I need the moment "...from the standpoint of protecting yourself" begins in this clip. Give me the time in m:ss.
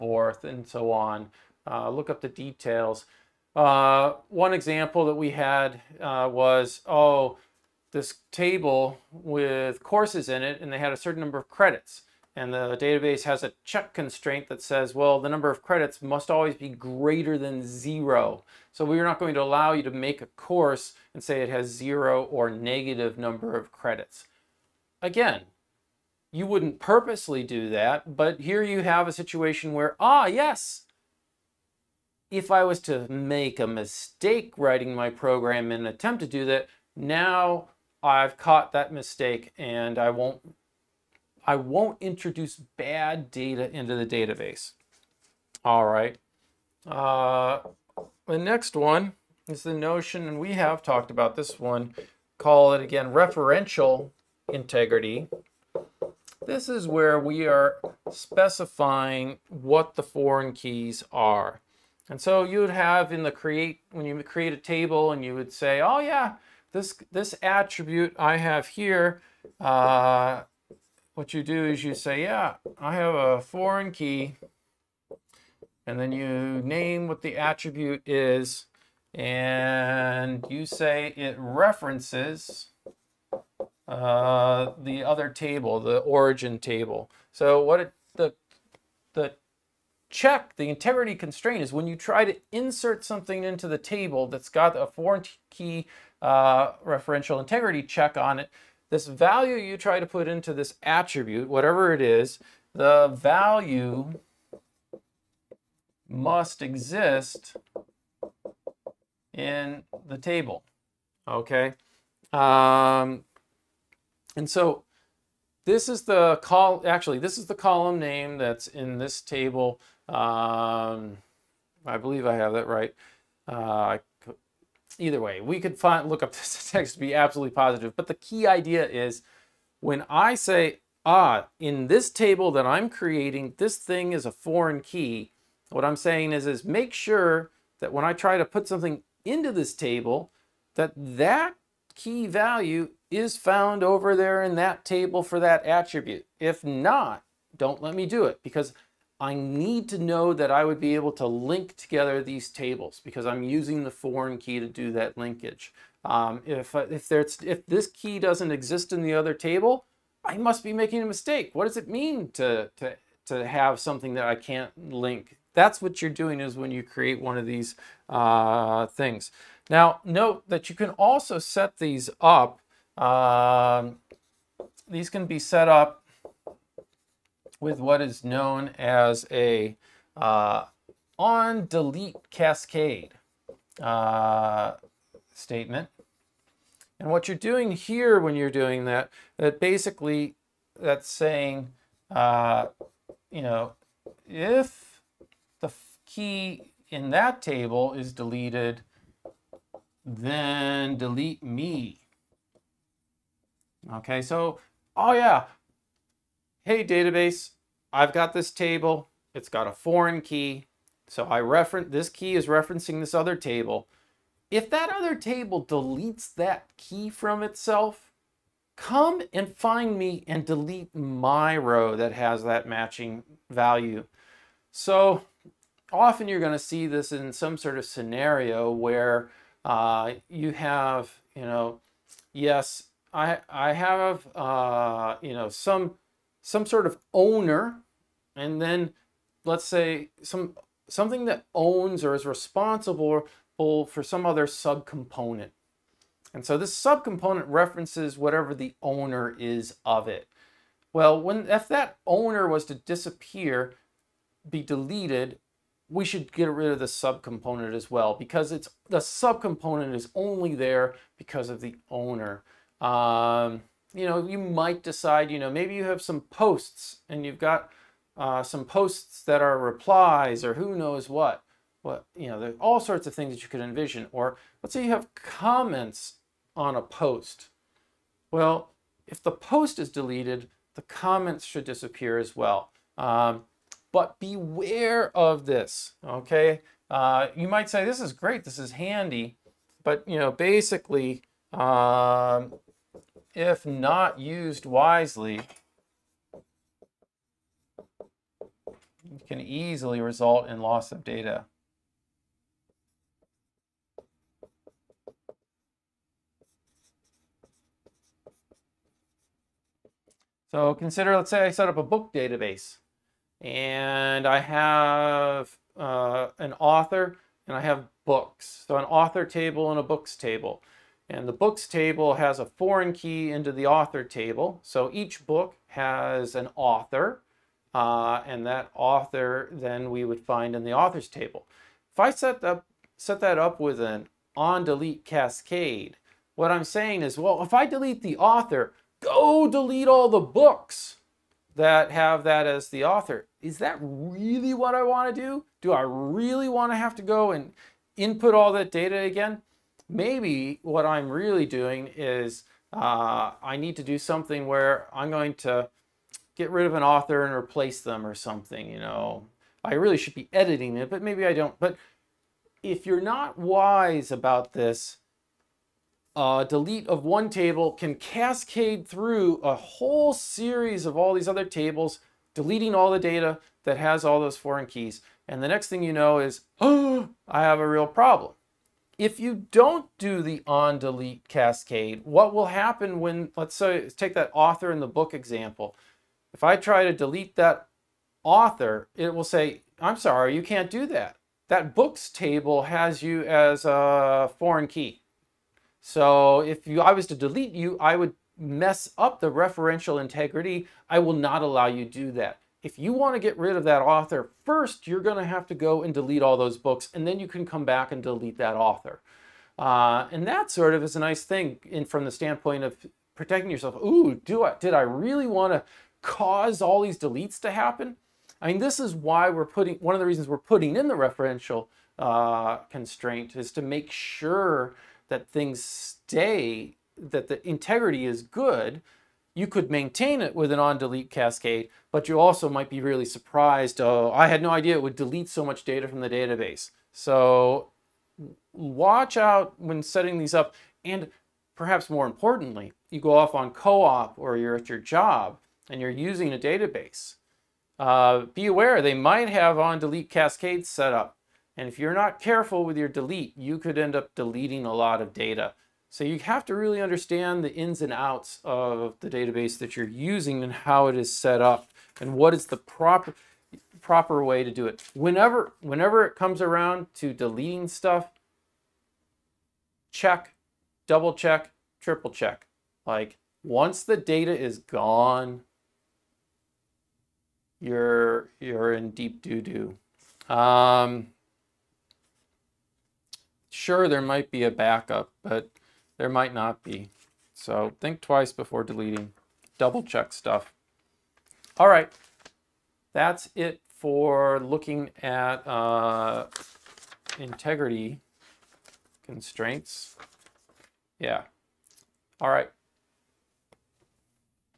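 6:51.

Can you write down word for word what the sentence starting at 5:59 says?
I really should be editing it, but maybe I don't.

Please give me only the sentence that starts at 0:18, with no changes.
So we're not going to allow you to make a course and say it has zero or negative number of credits.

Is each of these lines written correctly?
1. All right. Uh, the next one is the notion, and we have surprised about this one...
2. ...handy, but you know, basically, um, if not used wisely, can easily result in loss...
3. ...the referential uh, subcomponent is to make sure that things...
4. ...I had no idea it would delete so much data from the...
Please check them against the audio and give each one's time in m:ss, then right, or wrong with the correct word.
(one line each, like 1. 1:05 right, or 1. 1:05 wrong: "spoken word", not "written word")
1. 0:45 wrong: "talked", not "surprised"
2. 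4:48 right
3. 7:00 wrong: "constraint", not "subcomponent"
4. 7:14 right.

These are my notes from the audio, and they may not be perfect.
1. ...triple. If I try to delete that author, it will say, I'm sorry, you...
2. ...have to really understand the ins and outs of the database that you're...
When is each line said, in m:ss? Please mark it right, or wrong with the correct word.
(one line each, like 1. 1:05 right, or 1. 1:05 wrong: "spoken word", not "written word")
1. 6:25 wrong: "example", not "triple"
2. 7:36 right.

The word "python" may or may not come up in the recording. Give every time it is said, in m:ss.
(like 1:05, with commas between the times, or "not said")
not said.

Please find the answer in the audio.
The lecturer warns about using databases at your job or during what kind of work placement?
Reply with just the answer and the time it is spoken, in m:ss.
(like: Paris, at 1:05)
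co-op, at 7:23.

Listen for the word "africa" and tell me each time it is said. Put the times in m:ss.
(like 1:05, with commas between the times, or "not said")
not said.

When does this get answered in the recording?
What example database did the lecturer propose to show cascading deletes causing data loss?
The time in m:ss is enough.
5:11.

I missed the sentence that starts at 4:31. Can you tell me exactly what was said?
What you know, there's all sorts of things that you could envision.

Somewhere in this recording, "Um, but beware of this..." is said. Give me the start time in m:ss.
4:42.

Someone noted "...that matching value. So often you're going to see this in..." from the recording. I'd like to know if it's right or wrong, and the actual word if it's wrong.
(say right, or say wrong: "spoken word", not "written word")
right.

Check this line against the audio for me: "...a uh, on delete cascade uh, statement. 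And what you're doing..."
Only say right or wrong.
right.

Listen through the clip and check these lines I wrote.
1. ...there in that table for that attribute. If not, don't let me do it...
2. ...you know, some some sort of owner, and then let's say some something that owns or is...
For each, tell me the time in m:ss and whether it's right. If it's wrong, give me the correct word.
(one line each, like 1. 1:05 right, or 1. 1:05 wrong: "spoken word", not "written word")
1. 2:24 right
2. 3:55 right.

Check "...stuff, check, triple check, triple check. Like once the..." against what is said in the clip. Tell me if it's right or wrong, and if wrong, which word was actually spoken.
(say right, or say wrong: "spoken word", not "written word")
wrong: "double", not "triple".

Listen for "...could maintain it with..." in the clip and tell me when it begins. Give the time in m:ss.
7:09.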